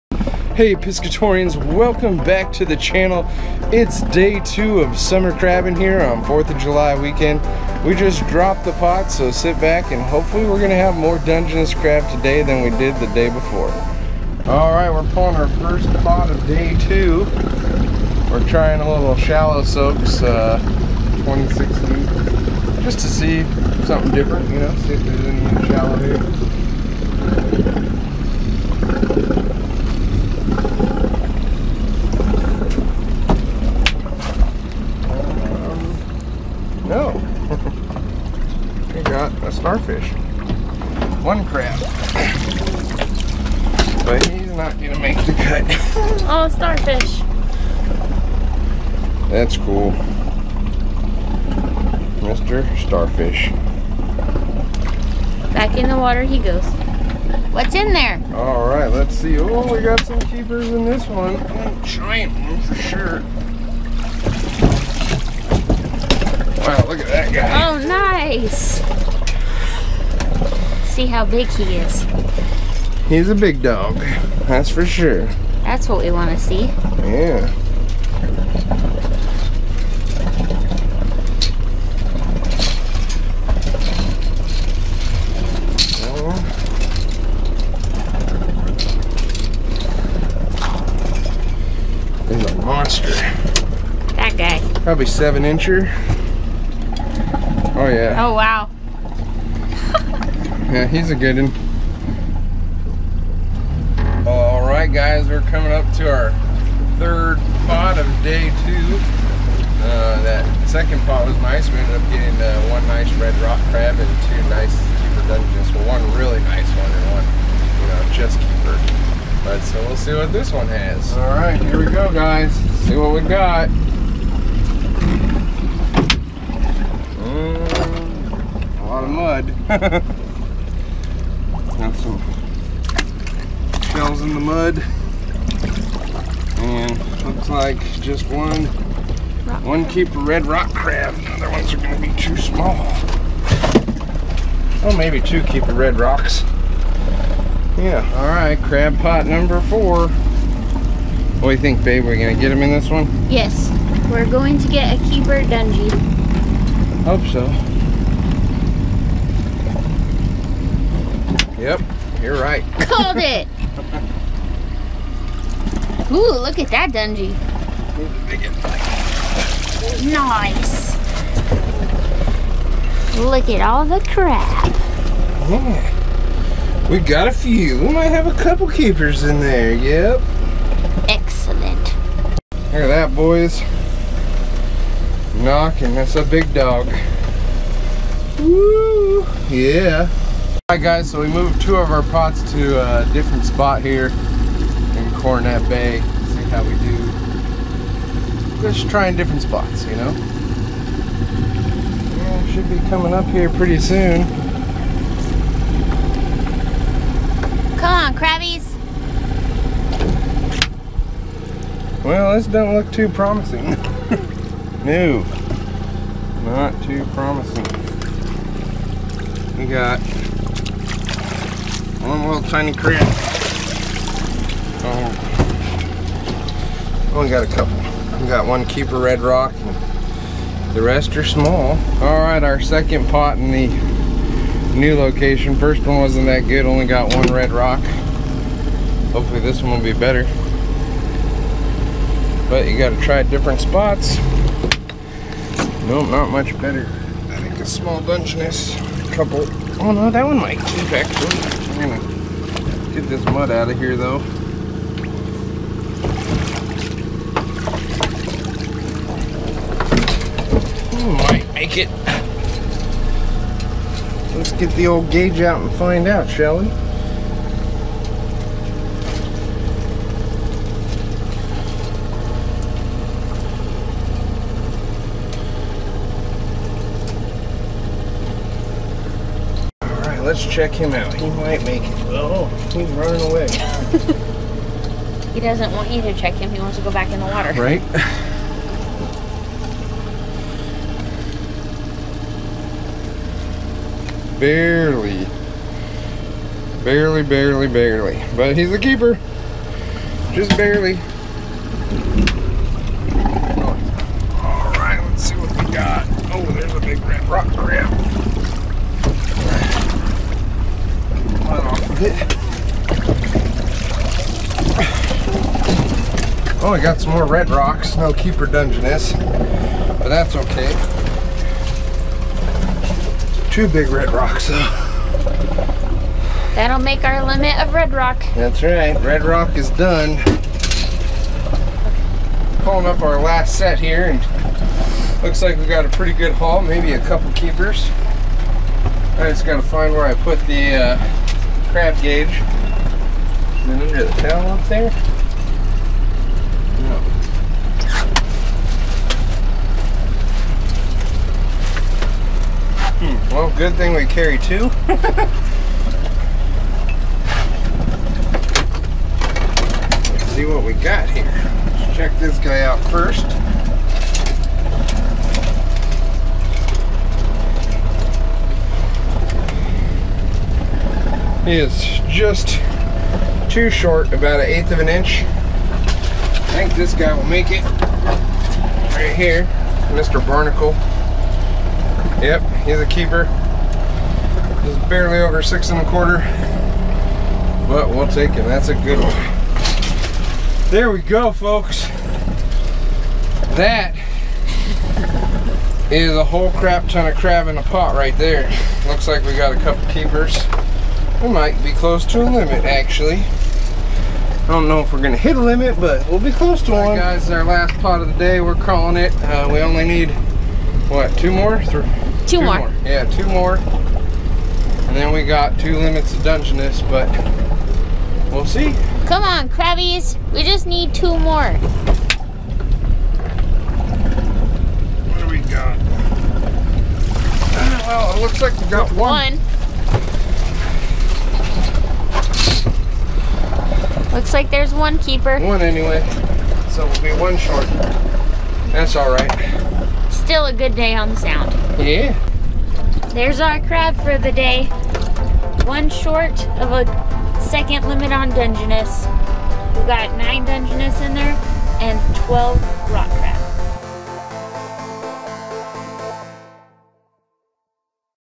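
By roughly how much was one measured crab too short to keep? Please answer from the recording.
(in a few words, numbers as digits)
an eighth of an inch.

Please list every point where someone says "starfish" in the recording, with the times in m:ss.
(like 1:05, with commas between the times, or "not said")
0:46, 0:52.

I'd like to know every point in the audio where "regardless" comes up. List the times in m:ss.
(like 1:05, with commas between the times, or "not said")
not said.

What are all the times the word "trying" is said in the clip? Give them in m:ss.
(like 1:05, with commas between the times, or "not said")
0:18, 3:18.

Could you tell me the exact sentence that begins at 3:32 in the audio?
Well, this don't look too promising.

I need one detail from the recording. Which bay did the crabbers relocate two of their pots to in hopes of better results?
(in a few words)
Cornet Bay.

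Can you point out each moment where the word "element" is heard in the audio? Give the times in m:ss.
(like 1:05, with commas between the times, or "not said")
not said.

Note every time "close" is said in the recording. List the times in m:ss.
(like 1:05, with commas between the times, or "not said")
6:41, 6:46.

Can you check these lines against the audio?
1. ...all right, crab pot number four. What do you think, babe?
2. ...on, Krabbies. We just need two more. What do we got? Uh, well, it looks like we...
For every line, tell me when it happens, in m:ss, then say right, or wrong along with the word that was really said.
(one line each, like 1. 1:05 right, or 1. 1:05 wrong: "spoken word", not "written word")
1. 2:28 right
2. 6:59 right.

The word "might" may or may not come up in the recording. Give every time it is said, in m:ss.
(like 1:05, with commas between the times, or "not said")
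2:57, 4:10, 4:21, 4:41, 6:41.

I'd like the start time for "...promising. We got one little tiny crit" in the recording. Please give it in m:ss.
3:37.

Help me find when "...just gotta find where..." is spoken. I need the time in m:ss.
5:39.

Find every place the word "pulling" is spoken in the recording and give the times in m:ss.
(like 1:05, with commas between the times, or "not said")
0:15, 5:32.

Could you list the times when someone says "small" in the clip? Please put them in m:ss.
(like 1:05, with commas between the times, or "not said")
2:22, 3:51, 4:07.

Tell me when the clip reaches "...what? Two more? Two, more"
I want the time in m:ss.
6:50.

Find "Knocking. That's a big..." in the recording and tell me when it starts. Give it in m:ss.
3:05.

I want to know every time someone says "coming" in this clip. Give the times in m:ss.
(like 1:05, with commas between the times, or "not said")
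1:45, 3:22.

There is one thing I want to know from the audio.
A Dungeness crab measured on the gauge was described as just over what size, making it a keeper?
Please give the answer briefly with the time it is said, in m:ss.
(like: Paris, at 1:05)
6 and a quarter, at 6:25.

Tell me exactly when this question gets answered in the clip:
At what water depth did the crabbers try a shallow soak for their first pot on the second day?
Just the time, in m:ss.
0:21.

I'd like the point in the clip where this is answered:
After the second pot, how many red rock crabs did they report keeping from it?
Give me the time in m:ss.
1:52.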